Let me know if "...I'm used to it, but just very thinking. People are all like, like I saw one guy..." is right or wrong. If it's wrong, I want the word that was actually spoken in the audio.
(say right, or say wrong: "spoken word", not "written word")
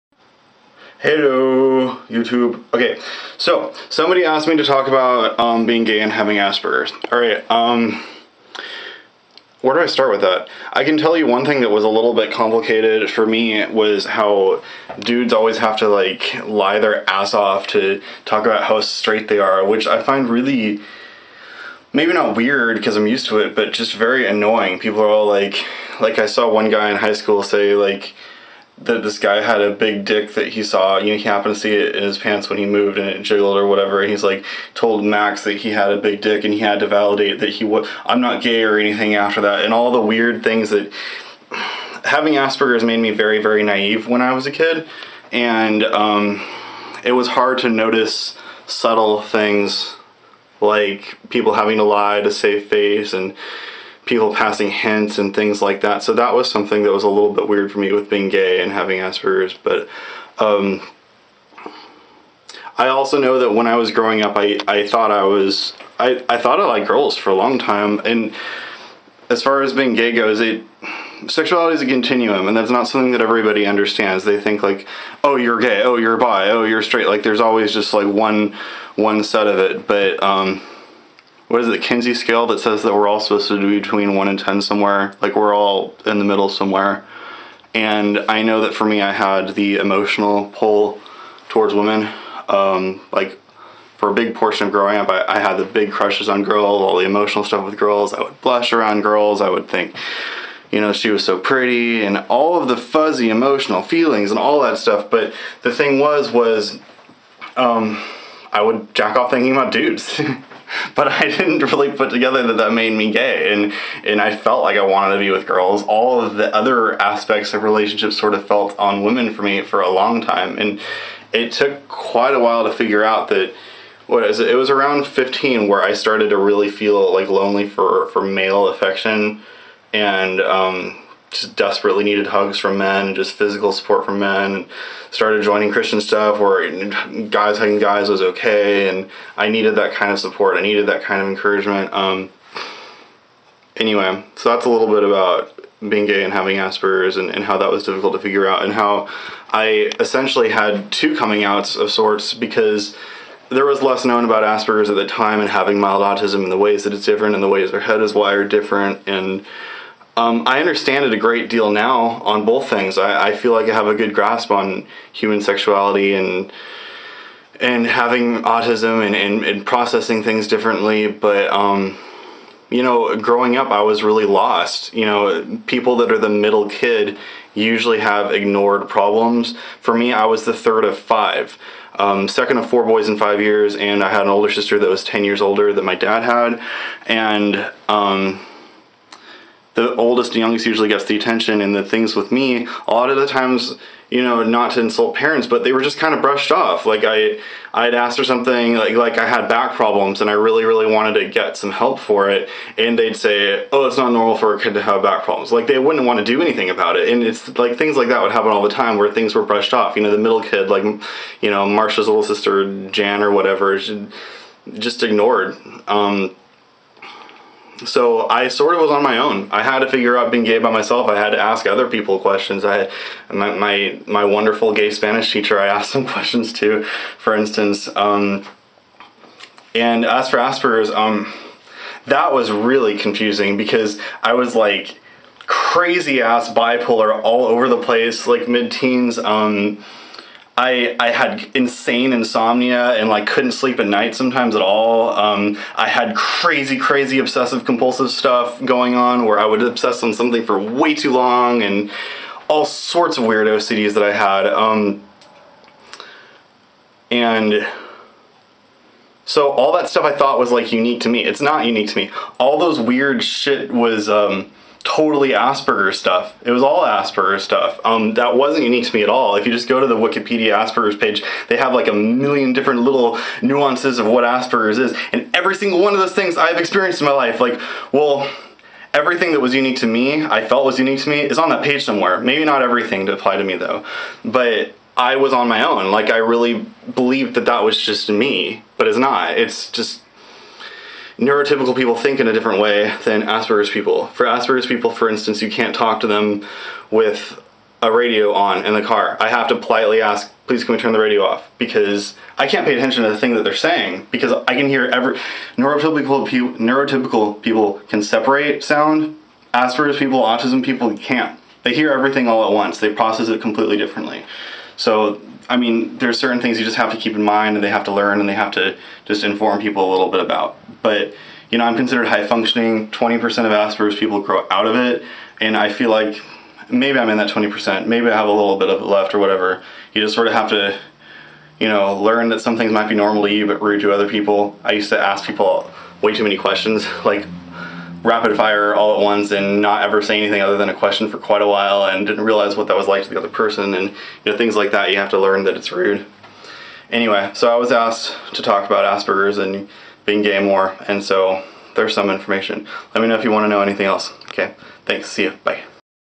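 wrong: "annoying", not "thinking".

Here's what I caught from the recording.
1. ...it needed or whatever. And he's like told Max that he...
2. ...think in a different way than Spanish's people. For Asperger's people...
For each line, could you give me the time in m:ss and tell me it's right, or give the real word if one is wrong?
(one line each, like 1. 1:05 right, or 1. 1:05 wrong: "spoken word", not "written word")
1. 0:33 wrong: "jiggled", not "needed"
2. 4:51 wrong: "Asperger", not "Spanish".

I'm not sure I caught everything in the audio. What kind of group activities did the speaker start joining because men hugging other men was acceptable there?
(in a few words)
Christian stuff.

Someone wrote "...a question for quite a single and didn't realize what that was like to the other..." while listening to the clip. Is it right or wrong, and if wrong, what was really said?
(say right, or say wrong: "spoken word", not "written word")
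wrong: "while", not "single".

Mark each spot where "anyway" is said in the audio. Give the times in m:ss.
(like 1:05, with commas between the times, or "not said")
2:23, 5:46.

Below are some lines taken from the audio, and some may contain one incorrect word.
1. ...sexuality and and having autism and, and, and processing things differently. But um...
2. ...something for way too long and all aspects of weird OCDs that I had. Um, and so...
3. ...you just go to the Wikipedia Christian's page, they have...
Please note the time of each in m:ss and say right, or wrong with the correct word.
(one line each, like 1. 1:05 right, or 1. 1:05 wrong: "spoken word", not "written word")
1. 2:45 right
2. 4:10 wrong: "sorts", not "aspects"
3. 4:29 wrong: "Asperger", not "Christian".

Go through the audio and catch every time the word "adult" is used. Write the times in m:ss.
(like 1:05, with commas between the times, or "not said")
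not said.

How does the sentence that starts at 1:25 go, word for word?
Like we're all in the middle somewhere.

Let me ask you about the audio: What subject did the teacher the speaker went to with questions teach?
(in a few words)
Spanish.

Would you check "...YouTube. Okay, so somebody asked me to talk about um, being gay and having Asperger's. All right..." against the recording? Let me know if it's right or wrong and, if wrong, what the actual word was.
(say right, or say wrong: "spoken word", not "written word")
right.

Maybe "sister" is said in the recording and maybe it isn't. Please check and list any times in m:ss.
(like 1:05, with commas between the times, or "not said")
3:04, 3:32.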